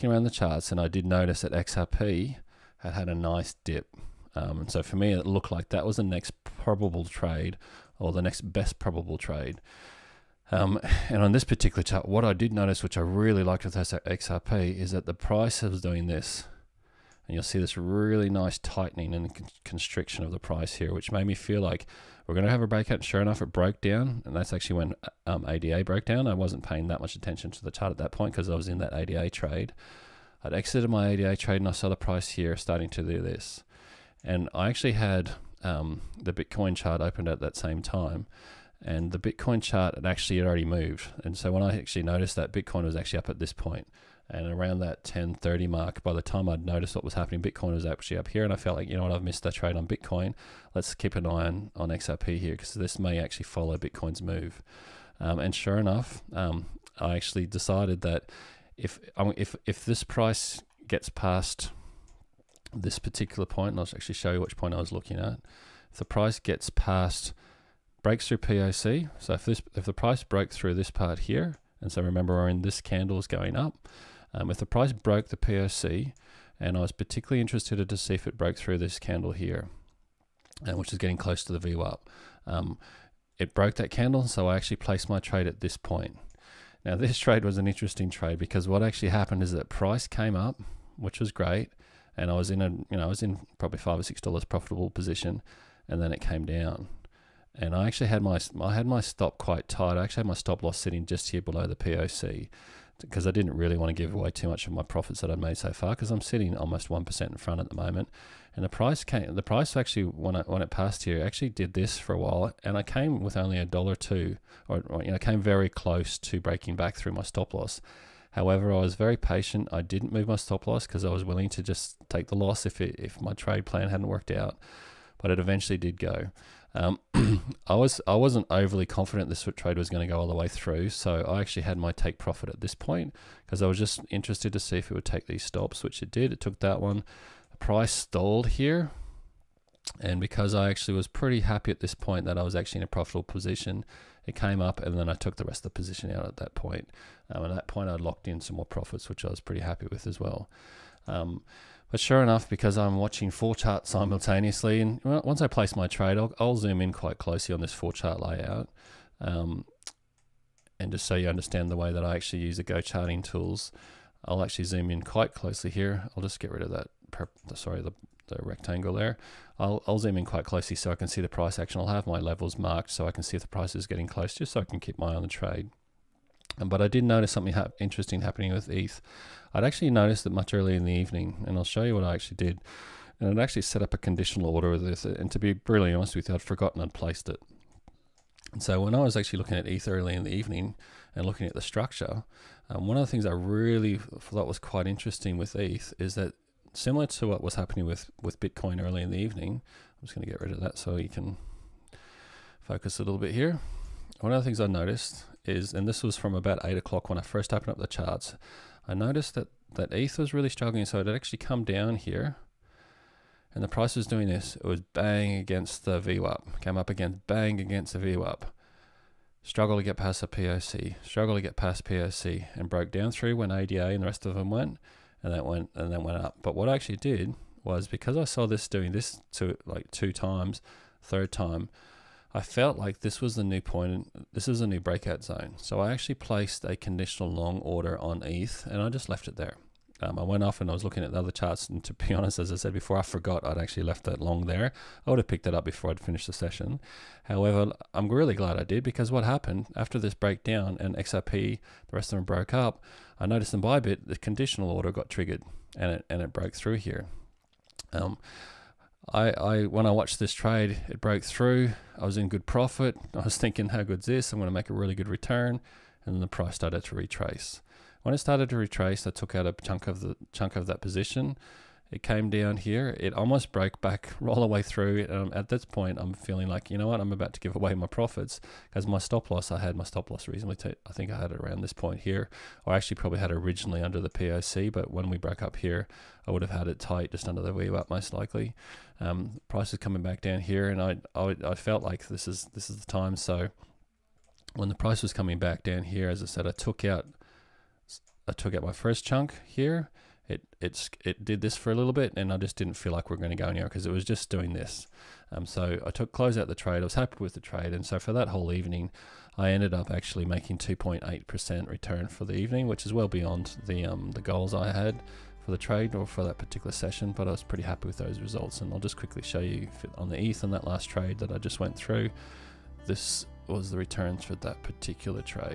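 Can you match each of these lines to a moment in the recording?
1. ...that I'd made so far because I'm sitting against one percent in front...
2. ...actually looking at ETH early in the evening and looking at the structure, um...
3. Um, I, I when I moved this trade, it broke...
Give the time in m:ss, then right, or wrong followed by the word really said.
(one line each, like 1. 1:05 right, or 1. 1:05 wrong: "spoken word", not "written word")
1. 1:45 wrong: "almost", not "against"
2. 3:09 right
3. 4:17 wrong: "watched", not "moved".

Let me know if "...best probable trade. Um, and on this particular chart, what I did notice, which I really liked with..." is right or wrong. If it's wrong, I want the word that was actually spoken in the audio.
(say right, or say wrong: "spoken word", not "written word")
right.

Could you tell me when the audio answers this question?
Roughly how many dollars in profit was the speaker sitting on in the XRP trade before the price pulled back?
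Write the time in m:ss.
1:33.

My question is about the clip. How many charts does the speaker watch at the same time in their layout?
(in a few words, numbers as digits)
4.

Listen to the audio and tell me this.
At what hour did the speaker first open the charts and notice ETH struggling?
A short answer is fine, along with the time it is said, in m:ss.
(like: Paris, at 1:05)
8 o'clock, at 3:26.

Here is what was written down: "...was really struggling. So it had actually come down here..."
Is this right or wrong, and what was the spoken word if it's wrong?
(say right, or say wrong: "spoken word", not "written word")
right.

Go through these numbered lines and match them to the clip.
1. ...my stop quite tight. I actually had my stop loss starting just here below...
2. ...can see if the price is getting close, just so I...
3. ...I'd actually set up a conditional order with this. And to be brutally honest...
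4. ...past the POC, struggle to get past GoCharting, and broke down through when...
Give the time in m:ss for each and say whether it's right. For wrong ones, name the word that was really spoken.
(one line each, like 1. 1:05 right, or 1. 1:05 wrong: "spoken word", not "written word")
1. 1:38 wrong: "sitting", not "starting"
2. 2:53 right
3. 3:03 right
4. 3:39 wrong: "POC", not "GoCharting".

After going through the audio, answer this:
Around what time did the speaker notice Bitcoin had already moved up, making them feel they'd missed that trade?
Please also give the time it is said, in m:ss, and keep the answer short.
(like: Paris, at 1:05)
10:30, at 0:45.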